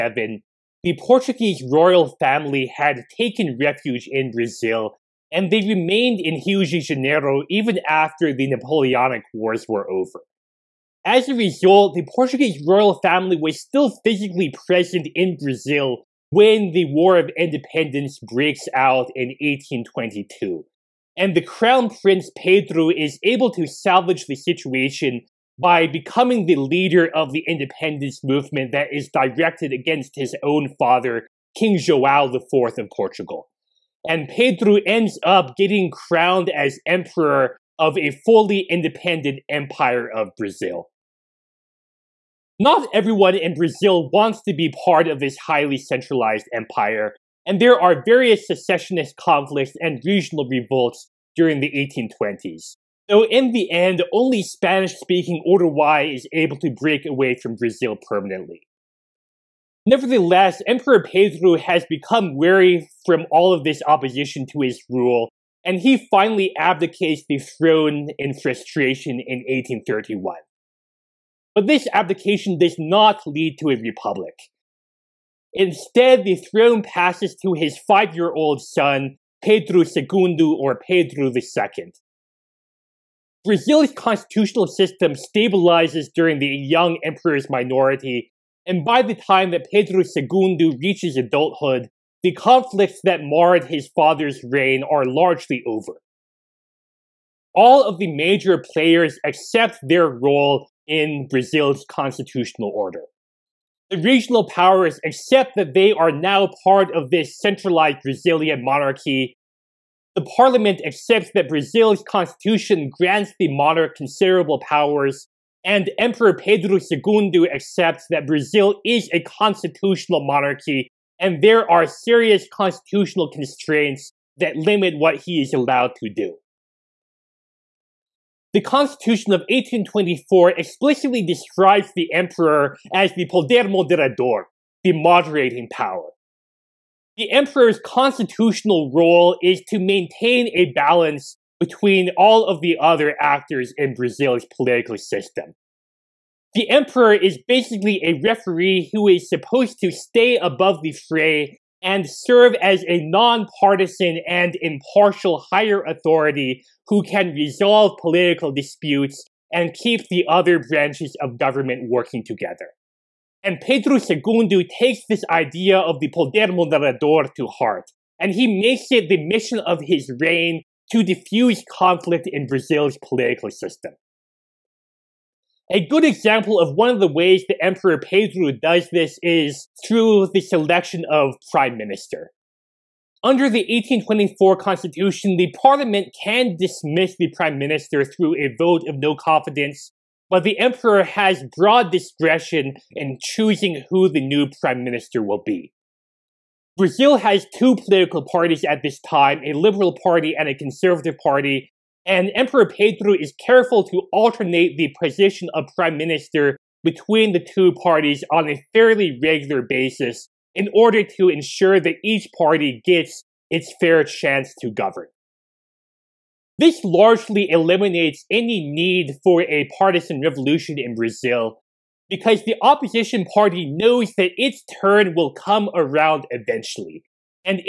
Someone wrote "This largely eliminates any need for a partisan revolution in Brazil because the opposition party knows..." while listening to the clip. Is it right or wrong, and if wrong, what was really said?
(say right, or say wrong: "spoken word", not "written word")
right.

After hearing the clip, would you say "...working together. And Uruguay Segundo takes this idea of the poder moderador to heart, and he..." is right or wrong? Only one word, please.
wrong.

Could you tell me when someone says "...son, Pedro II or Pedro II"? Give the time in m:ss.
1:18.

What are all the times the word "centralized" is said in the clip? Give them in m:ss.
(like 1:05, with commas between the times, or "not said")
0:45, 1:47.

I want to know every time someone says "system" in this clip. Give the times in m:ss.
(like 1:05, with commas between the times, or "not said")
1:24, 2:24, 2:53.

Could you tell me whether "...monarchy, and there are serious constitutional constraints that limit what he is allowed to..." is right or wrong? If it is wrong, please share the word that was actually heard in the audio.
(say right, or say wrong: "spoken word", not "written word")
right.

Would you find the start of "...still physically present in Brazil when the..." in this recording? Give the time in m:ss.
0:13.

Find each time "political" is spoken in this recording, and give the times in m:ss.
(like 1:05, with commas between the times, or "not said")
2:24, 2:38, 2:53, 3:17.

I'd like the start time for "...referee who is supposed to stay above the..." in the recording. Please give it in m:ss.
2:28.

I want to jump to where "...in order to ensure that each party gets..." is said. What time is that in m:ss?
3:30.